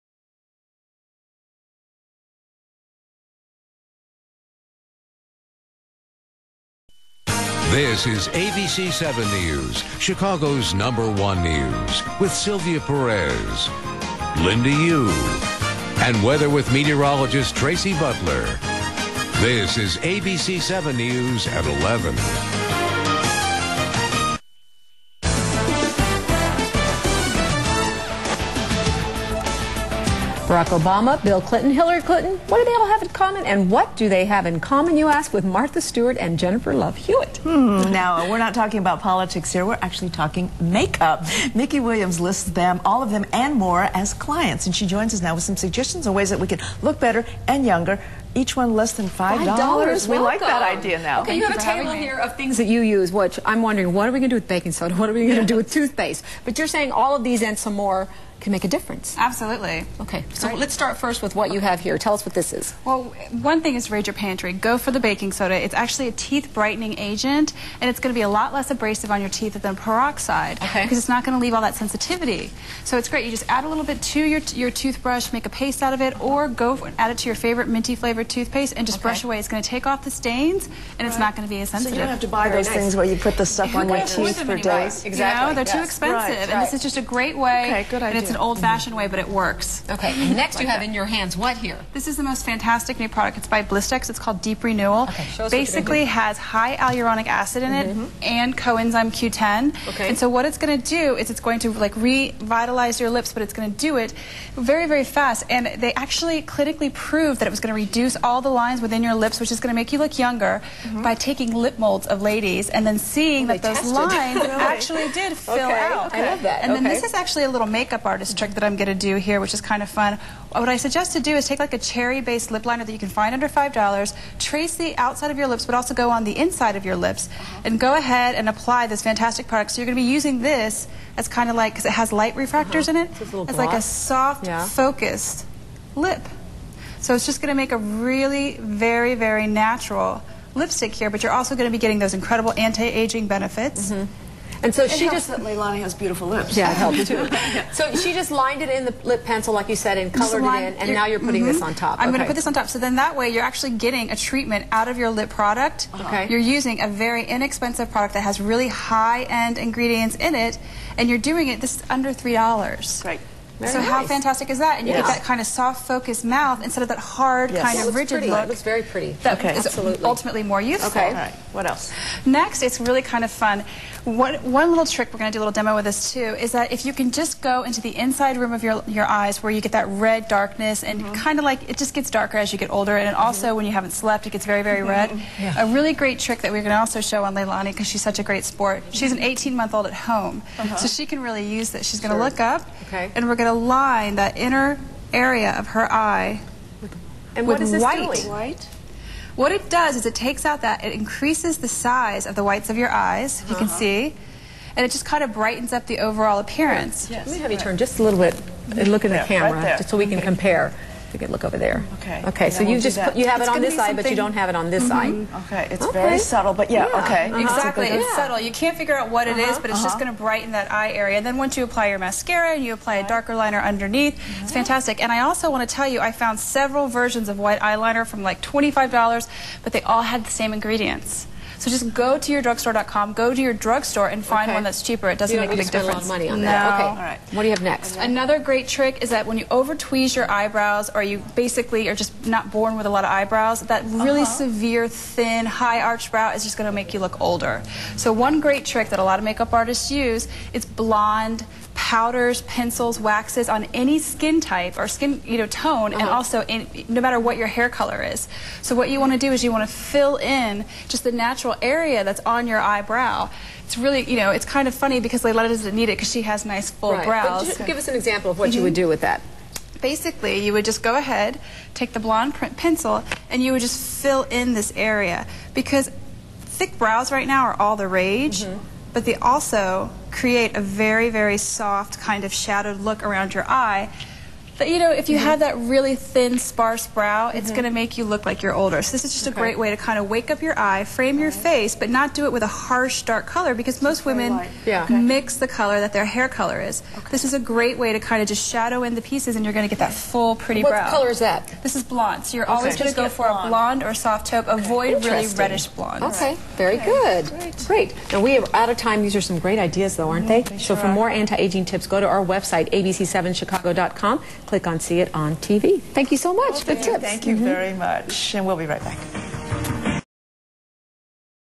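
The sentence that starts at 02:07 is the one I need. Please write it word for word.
and go ahead and apply this fantastic product.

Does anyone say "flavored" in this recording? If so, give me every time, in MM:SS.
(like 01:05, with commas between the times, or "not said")
01:17.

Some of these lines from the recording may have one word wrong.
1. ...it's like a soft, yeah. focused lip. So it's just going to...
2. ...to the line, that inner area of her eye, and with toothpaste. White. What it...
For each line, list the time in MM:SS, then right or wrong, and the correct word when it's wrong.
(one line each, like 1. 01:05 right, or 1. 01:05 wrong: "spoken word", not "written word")
1. 02:13 right
2. 03:13 wrong: "white", not "toothpaste".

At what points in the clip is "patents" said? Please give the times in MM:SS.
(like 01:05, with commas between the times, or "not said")
not said.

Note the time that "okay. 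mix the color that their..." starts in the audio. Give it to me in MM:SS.
04:54.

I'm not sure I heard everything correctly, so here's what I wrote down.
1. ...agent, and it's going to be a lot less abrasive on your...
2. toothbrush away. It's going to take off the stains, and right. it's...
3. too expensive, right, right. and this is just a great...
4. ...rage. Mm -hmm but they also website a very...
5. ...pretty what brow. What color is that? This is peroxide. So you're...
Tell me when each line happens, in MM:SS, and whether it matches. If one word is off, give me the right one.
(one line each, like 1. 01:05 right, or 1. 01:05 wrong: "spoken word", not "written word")
1. 01:06 right
2. 01:19 wrong: "brush", not "toothbrush"
3. 01:25 right
4. 04:38 wrong: "create", not "website"
5. 05:00 wrong: "blonde", not "peroxide".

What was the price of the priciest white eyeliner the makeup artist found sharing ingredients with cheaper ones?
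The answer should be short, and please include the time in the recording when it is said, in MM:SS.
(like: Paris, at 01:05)
$25, at 03:48.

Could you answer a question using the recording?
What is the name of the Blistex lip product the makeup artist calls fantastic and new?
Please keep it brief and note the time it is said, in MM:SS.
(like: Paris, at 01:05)
Deep Renewal, at 01:34.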